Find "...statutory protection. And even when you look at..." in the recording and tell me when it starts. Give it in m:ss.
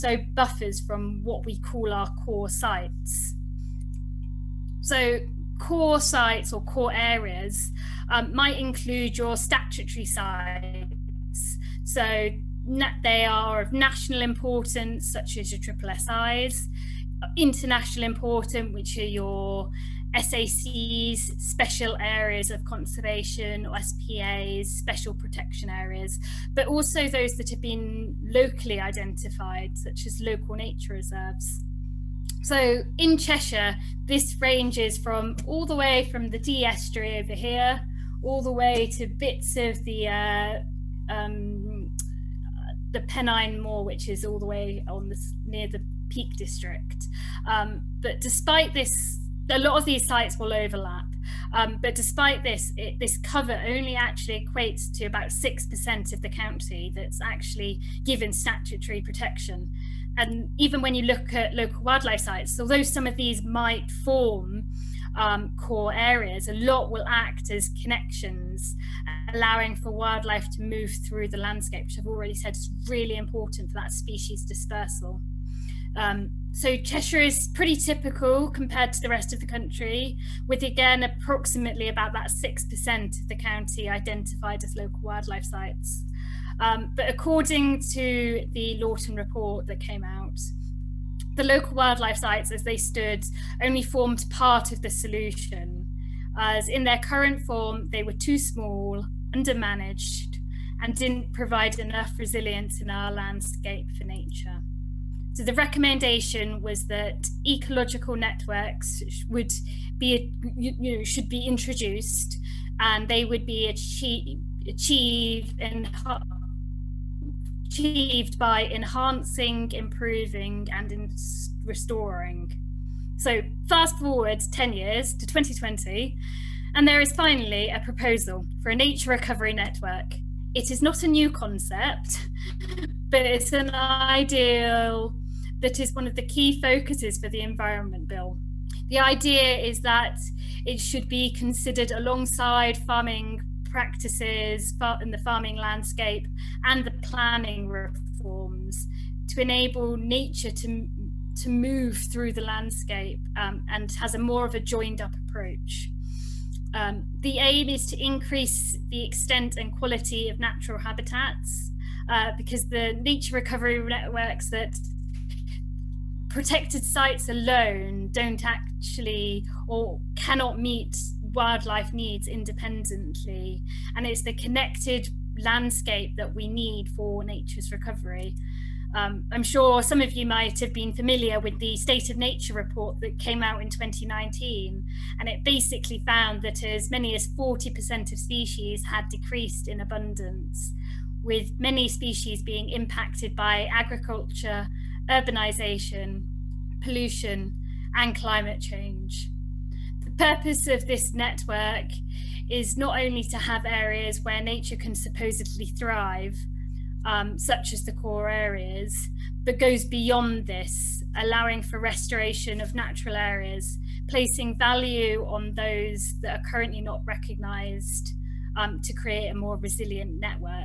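0:58.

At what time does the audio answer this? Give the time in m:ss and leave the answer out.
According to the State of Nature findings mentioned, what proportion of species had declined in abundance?
3:07.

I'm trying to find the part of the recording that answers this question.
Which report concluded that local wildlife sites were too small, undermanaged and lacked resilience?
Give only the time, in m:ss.
1:28.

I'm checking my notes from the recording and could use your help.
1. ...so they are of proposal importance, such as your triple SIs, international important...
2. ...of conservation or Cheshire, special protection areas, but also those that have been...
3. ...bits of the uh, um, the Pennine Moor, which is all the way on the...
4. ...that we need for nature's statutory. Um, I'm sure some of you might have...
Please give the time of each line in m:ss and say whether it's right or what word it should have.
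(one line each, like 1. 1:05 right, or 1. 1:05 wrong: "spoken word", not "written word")
1. 0:11 wrong: "national", not "proposal"
2. 0:22 wrong: "SPAs", not "Cheshire"
3. 0:39 right
4. 2:56 wrong: "recovery", not "statutory".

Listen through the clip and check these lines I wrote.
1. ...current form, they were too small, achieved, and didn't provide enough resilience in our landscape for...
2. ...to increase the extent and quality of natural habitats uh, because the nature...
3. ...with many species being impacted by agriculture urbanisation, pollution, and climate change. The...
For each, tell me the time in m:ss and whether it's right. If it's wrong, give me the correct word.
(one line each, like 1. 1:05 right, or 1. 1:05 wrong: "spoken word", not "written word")
1. 1:36 wrong: "undermanaged", not "achieved"
2. 2:37 right
3. 3:11 right.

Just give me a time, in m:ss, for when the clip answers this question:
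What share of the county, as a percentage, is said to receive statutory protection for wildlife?
0:55.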